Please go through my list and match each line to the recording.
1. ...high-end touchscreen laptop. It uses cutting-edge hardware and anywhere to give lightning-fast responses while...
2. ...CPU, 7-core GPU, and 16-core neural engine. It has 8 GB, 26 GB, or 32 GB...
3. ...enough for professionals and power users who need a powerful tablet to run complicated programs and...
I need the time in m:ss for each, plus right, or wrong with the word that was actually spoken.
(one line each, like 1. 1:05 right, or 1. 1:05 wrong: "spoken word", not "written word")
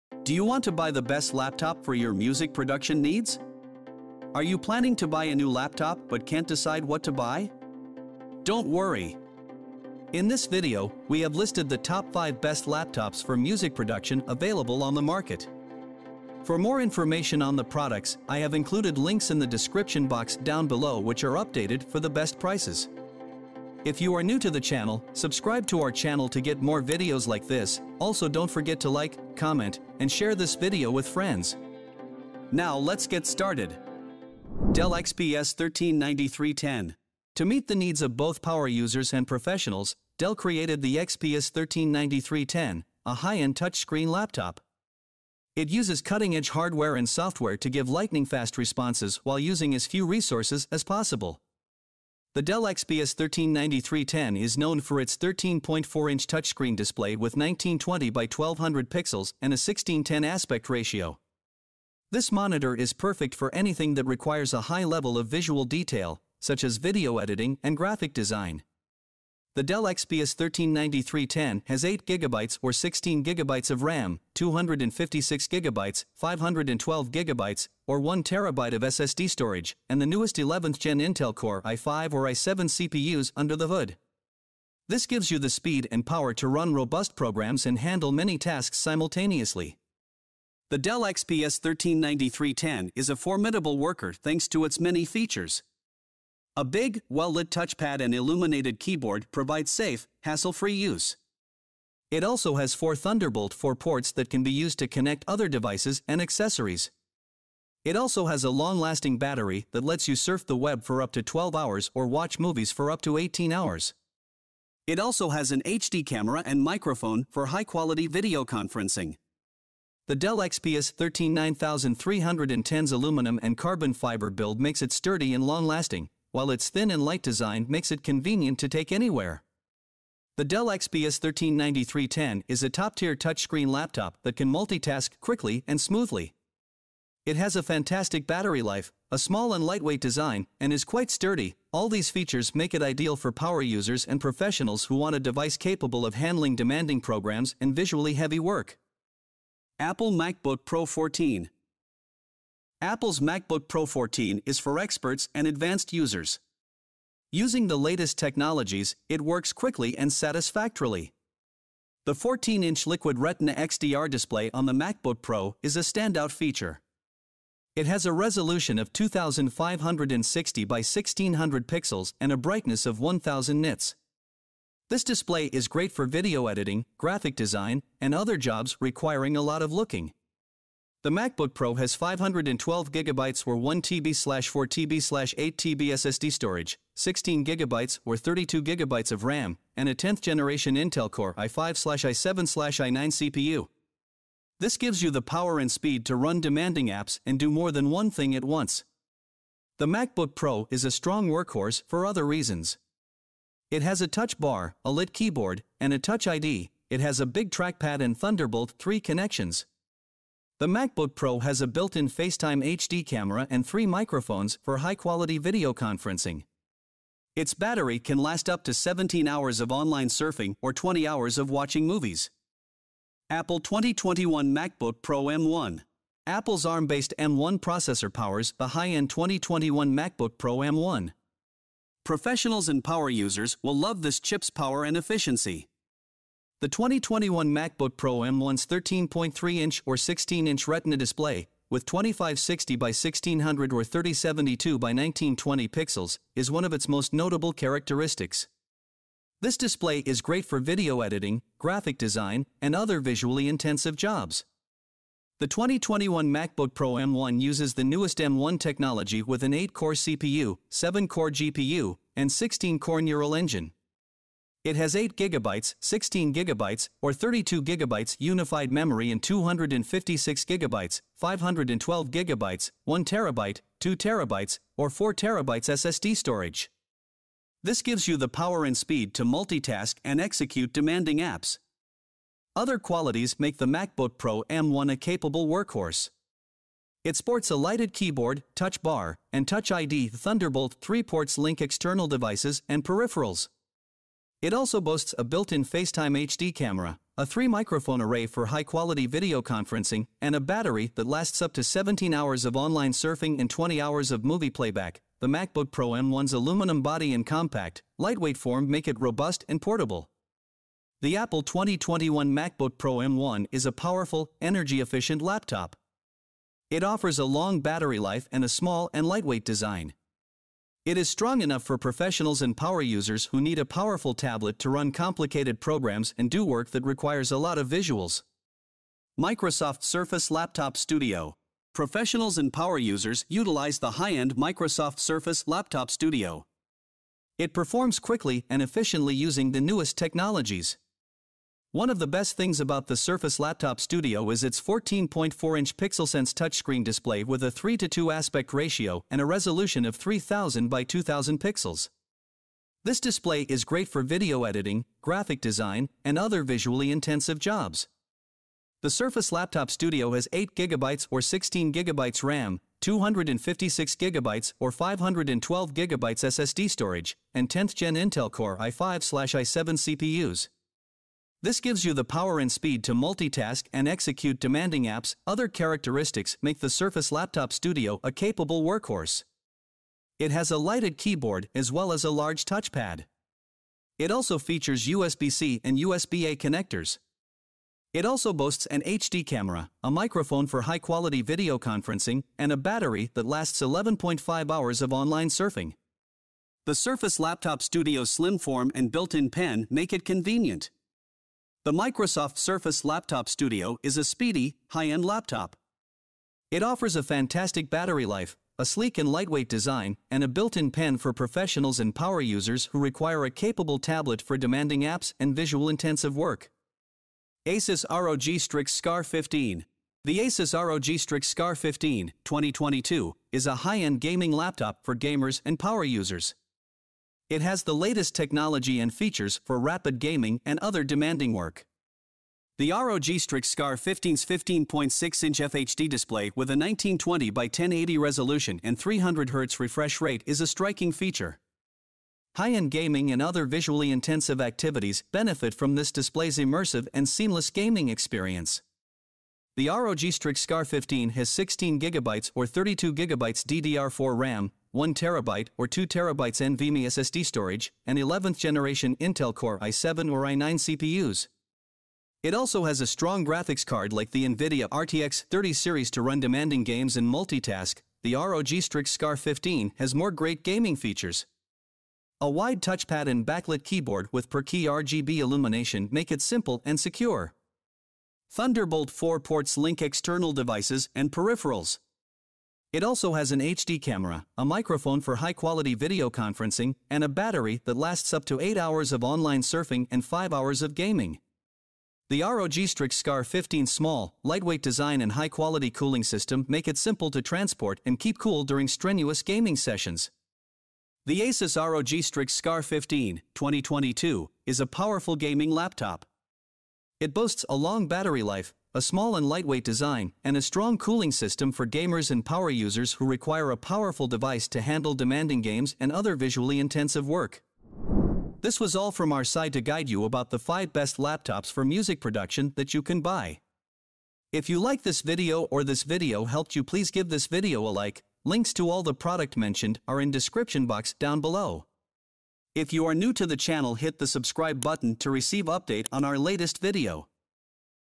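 1. 0:43 wrong: "software", not "anywhere"
2. 4:19 wrong: "16", not "26"
3. 5:21 right.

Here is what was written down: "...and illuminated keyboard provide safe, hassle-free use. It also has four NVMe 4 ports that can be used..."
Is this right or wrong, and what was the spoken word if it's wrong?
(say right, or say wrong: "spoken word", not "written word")
wrong: "Thunderbolt", not "NVMe".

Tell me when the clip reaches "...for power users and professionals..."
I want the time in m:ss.
2:23.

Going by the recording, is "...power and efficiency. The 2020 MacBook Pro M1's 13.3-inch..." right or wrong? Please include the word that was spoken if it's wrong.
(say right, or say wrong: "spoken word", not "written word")
wrong: "2021", not "2020".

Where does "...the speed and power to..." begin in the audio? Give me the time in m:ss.
1:25.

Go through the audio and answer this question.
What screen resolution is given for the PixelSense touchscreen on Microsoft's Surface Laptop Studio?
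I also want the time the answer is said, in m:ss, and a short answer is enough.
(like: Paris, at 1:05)
3000 by 2000, at 5:49.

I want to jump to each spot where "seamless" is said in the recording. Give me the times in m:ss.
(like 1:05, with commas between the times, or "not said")
7:27.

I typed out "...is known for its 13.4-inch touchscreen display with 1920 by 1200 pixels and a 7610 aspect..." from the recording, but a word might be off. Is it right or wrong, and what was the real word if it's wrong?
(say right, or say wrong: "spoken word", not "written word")
wrong: "1610", not "7610".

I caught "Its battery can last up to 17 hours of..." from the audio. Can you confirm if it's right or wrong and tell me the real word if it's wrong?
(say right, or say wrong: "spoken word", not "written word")
right.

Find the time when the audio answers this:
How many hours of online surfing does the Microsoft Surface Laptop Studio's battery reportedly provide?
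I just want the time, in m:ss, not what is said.
6:33.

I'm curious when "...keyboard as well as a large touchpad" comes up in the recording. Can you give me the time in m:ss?
6:20.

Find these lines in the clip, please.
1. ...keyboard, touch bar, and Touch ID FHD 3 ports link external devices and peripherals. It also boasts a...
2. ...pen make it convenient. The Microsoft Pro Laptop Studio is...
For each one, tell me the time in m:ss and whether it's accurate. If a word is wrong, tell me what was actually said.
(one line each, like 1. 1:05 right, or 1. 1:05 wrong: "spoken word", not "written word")
1. 4:47 wrong: "Thunderbolt", not "FHD"
2. 6:39 wrong: "Surface", not "Pro".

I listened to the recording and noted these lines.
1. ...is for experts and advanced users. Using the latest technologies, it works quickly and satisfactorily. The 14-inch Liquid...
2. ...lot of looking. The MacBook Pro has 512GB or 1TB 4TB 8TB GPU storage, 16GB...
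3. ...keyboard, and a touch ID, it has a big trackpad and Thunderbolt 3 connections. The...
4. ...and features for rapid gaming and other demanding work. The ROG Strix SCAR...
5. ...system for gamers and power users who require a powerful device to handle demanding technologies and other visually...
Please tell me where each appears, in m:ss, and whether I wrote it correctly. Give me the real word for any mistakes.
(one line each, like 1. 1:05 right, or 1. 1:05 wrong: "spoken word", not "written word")
1. 2:34 right
2. 2:59 wrong: "SSD", not "GPU"
3. 3:25 right
4. 7:08 right
5. 8:31 wrong: "games", not "technologies".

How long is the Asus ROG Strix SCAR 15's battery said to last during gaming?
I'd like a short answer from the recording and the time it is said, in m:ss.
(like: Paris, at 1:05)
5 hours, at 8:10.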